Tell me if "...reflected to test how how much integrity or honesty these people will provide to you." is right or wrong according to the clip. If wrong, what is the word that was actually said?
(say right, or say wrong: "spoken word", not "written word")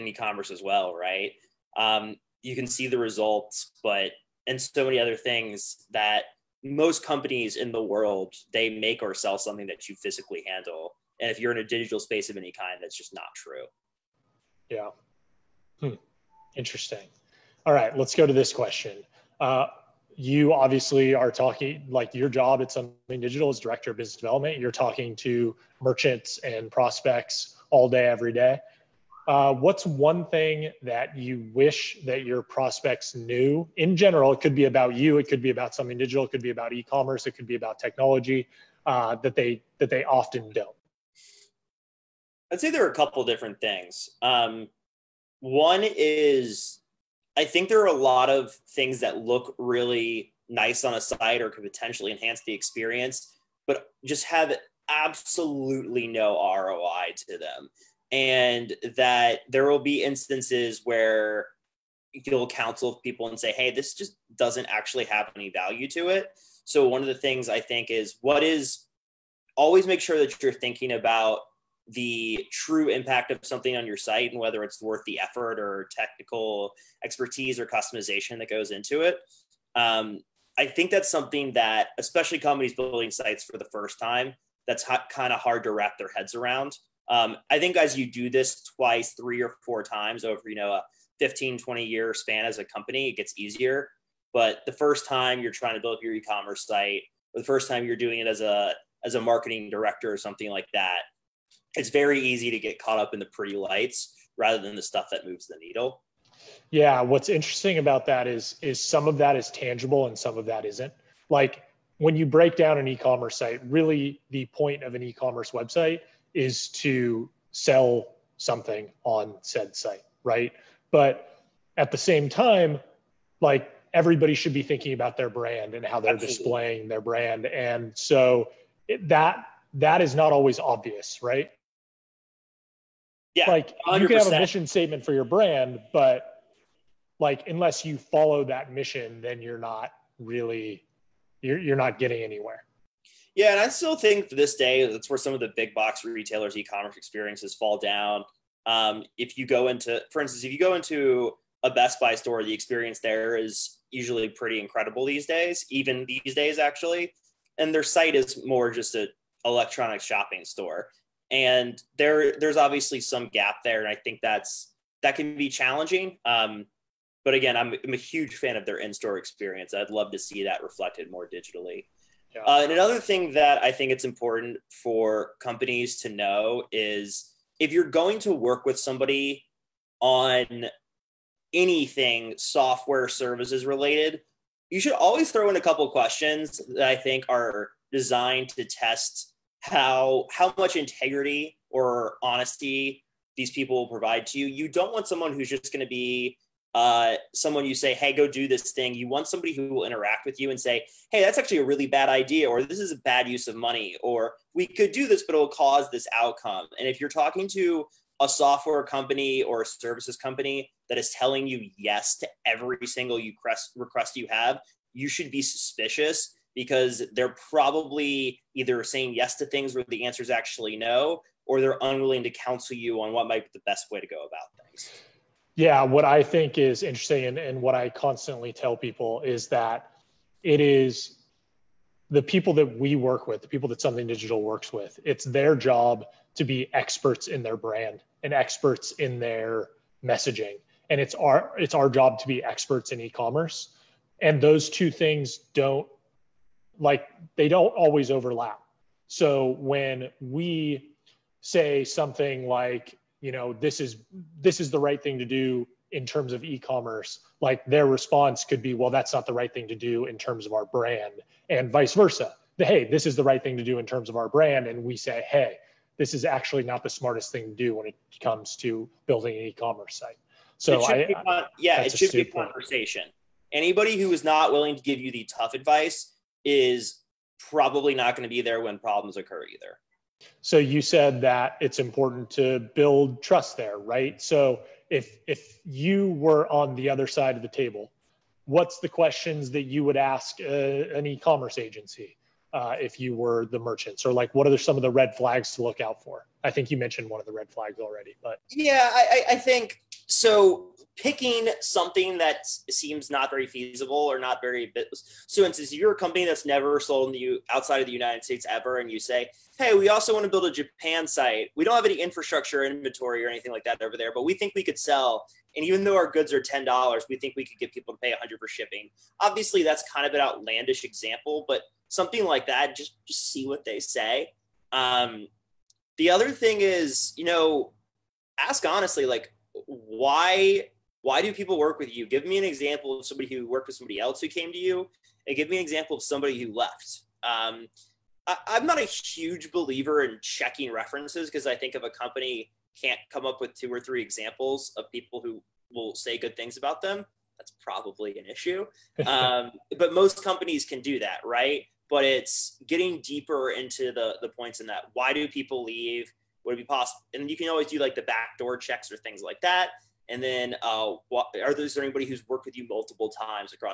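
wrong: "designed", not "reflected".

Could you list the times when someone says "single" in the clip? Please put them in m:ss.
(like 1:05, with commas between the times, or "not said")
3:32.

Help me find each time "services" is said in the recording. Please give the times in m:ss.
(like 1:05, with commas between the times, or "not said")
3:03, 3:29.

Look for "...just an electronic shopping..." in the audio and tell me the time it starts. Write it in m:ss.
2:38.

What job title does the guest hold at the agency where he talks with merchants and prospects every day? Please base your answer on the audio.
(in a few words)
Director of business development.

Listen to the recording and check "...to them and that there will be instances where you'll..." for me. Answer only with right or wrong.
right.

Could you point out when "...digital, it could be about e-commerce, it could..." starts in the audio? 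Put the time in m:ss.
0:35.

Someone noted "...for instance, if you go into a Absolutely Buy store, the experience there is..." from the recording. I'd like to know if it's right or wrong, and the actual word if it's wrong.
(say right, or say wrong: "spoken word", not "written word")
wrong: "Best", not "Absolutely".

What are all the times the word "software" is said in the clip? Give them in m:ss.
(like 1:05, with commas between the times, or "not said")
3:02, 3:28.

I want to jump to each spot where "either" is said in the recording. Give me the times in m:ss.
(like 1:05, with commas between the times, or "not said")
3:38, 4:39.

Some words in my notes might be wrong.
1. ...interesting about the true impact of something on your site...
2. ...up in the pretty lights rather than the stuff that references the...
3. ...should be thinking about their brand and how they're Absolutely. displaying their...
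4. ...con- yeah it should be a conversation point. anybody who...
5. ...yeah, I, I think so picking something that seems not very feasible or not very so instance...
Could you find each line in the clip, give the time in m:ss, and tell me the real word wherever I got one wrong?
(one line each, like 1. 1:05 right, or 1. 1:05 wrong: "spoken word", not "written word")
1. 1:10 wrong: "thinking", not "interesting"
2. 1:42 wrong: "moves", not "references"
3. 2:04 right
4. 4:31 right
5. 4:58 right.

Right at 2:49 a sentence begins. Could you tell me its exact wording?
I'd love to see that reflected more digitally.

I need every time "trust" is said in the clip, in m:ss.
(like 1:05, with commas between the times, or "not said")
4:43.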